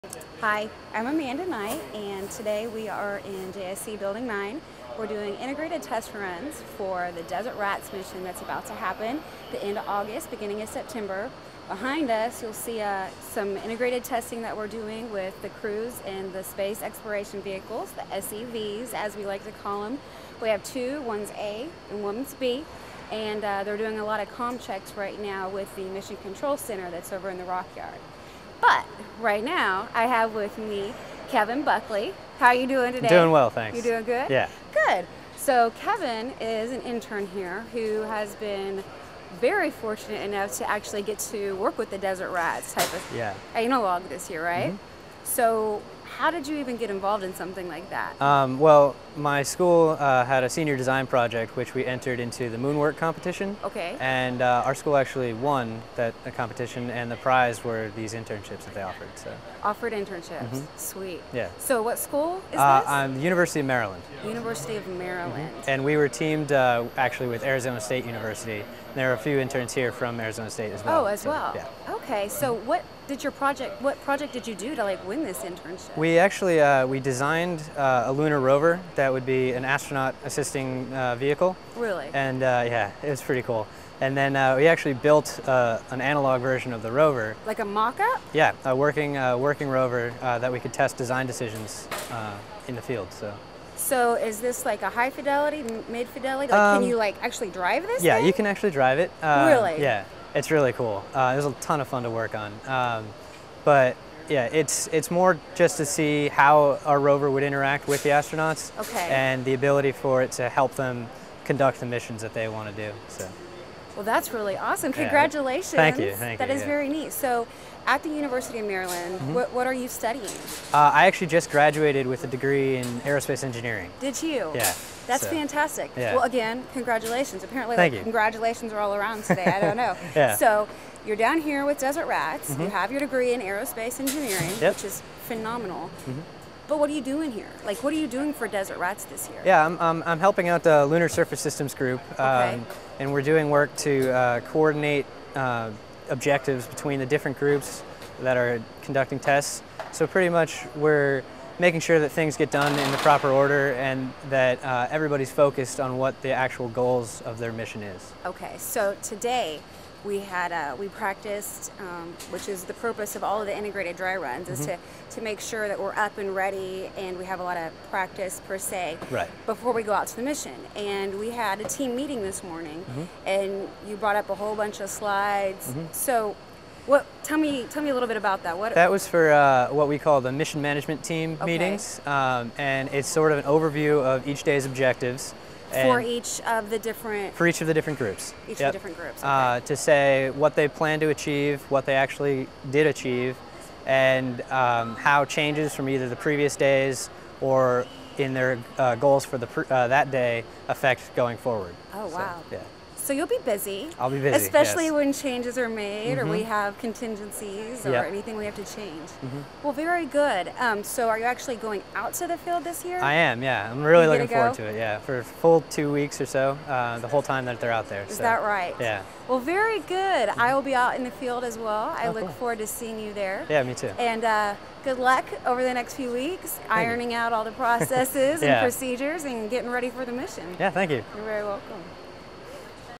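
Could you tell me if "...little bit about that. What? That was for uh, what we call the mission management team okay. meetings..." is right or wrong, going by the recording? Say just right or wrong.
right.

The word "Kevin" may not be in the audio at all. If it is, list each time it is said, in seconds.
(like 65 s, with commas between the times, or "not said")
31 s, 35 s.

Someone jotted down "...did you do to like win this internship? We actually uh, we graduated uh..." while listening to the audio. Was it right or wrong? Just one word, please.
wrong.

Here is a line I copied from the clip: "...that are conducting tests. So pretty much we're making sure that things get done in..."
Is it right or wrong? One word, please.
right.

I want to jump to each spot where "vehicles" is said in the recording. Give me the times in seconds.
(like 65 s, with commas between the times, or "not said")
17 s, 81 s.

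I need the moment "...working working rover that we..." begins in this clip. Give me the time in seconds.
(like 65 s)
88 s.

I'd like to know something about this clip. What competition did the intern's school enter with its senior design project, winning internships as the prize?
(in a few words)
Moonwork.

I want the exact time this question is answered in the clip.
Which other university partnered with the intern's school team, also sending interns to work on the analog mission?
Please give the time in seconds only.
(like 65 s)
67 s.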